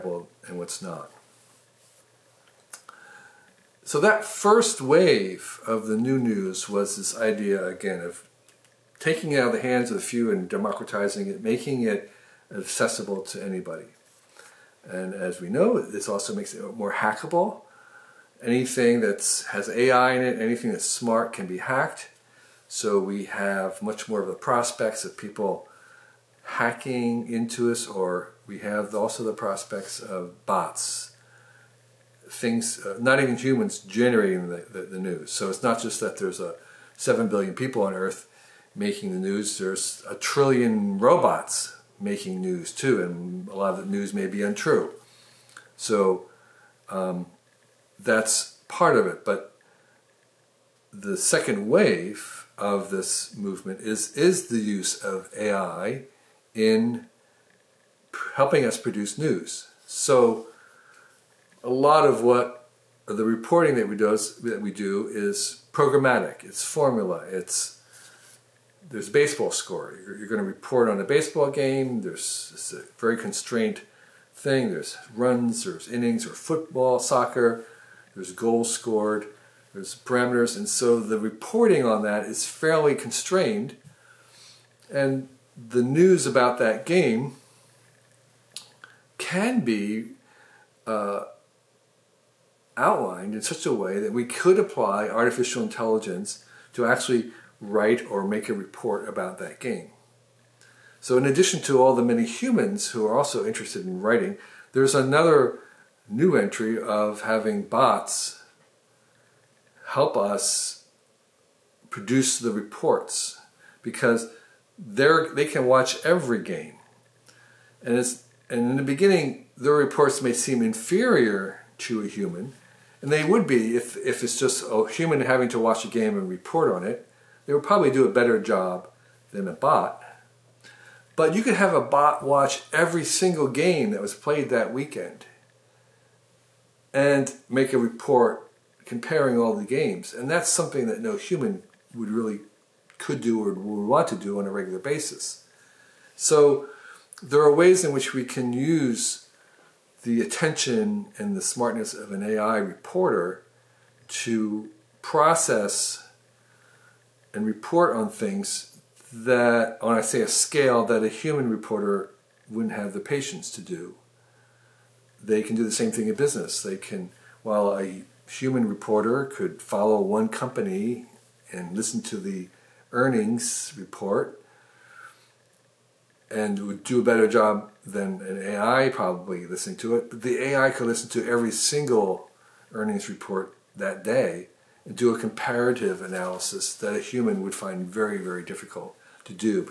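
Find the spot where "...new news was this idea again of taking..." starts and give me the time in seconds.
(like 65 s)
5 s.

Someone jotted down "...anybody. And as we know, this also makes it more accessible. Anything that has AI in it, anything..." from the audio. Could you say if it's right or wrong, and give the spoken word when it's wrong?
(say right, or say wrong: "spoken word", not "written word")
wrong: "hackable", not "accessible".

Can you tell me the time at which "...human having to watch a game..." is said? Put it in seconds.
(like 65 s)
124 s.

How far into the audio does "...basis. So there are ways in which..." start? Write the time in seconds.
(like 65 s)
144 s.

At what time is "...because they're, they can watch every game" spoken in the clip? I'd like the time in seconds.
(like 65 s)
113 s.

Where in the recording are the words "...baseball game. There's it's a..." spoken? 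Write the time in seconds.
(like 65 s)
71 s.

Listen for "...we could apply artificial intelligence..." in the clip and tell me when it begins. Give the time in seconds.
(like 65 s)
94 s.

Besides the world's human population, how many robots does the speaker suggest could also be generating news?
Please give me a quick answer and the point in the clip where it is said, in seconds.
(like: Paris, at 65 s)
a trillion, at 40 s.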